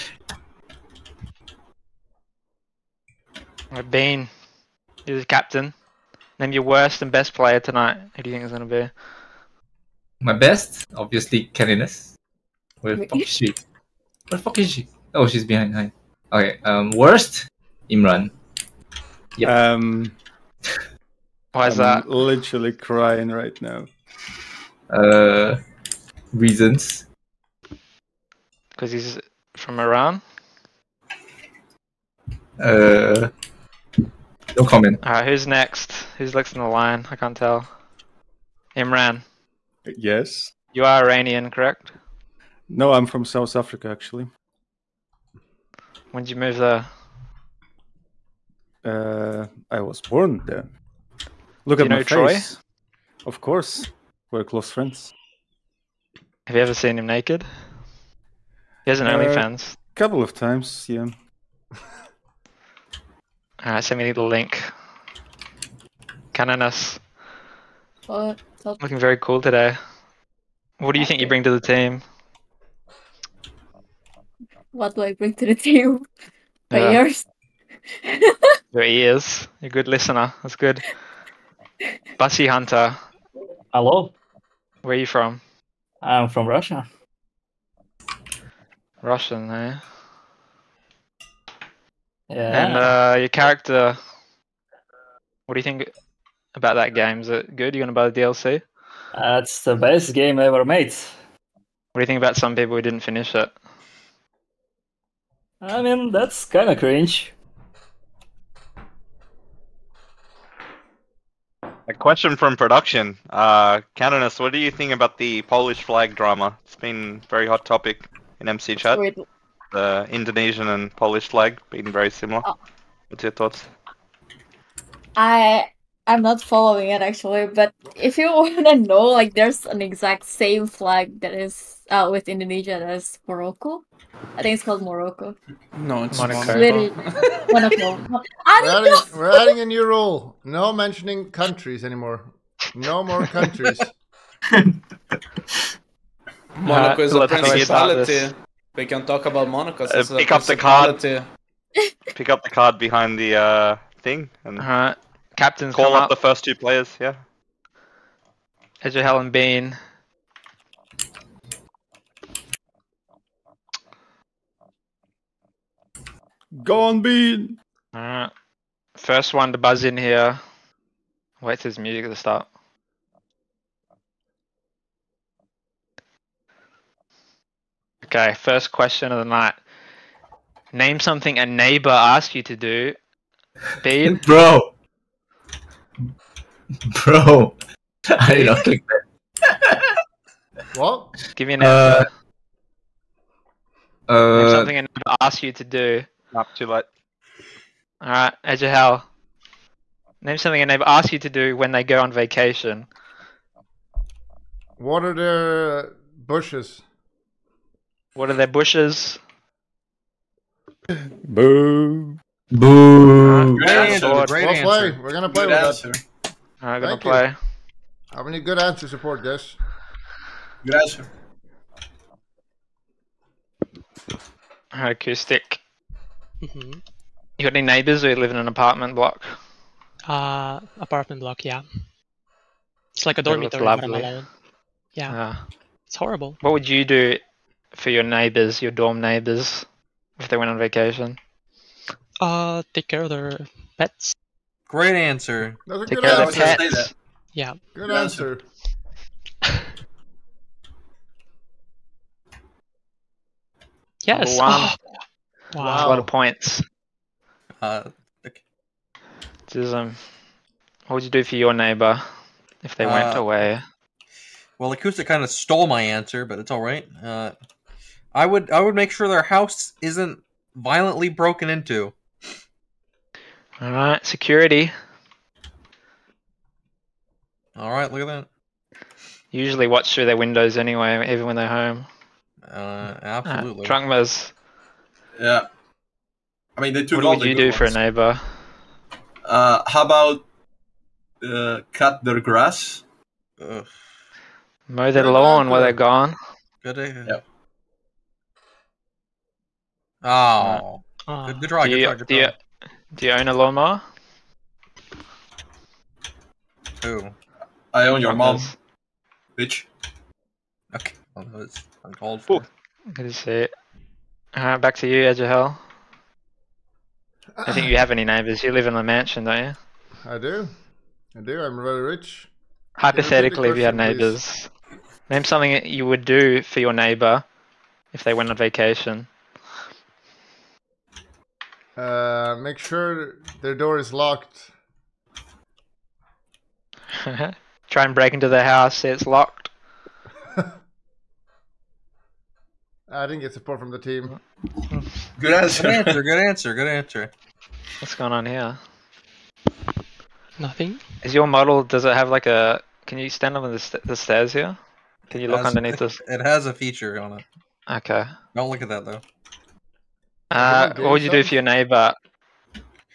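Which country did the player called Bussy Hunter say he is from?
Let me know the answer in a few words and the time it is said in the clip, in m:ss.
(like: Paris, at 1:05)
Russia, at 1:26.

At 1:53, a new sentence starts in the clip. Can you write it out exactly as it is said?
Uh, Canonus, what do you think about the Polish flag drama?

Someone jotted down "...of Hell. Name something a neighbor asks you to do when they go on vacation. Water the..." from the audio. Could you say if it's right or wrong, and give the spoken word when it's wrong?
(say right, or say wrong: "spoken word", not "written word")
right.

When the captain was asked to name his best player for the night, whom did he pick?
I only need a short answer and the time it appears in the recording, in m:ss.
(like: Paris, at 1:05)
Kennyness, at 0:11.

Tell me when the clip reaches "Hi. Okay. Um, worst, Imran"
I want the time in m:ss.
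0:15.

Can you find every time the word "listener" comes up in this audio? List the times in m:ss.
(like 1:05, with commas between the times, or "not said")
1:19.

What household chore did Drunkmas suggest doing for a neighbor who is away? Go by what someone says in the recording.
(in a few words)
Cut their grass.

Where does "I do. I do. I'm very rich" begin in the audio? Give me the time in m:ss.
5:20.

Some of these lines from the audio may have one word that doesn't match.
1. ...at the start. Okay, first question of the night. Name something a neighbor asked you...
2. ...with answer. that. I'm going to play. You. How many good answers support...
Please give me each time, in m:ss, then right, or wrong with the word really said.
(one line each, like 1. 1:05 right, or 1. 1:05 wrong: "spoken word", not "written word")
1. 2:52 right
2. 3:35 right.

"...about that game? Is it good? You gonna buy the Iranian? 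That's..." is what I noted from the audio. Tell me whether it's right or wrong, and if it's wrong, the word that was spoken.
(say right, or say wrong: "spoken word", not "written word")
wrong: "DLC", not "Iranian".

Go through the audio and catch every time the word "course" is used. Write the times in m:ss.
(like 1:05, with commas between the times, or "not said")
0:53.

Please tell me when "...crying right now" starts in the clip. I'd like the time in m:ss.
0:22.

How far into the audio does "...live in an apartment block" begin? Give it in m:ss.
3:48.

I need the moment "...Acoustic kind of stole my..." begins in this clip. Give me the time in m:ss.
4:24.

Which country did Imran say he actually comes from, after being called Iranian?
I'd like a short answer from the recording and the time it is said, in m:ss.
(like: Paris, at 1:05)
South Africa, at 0:43.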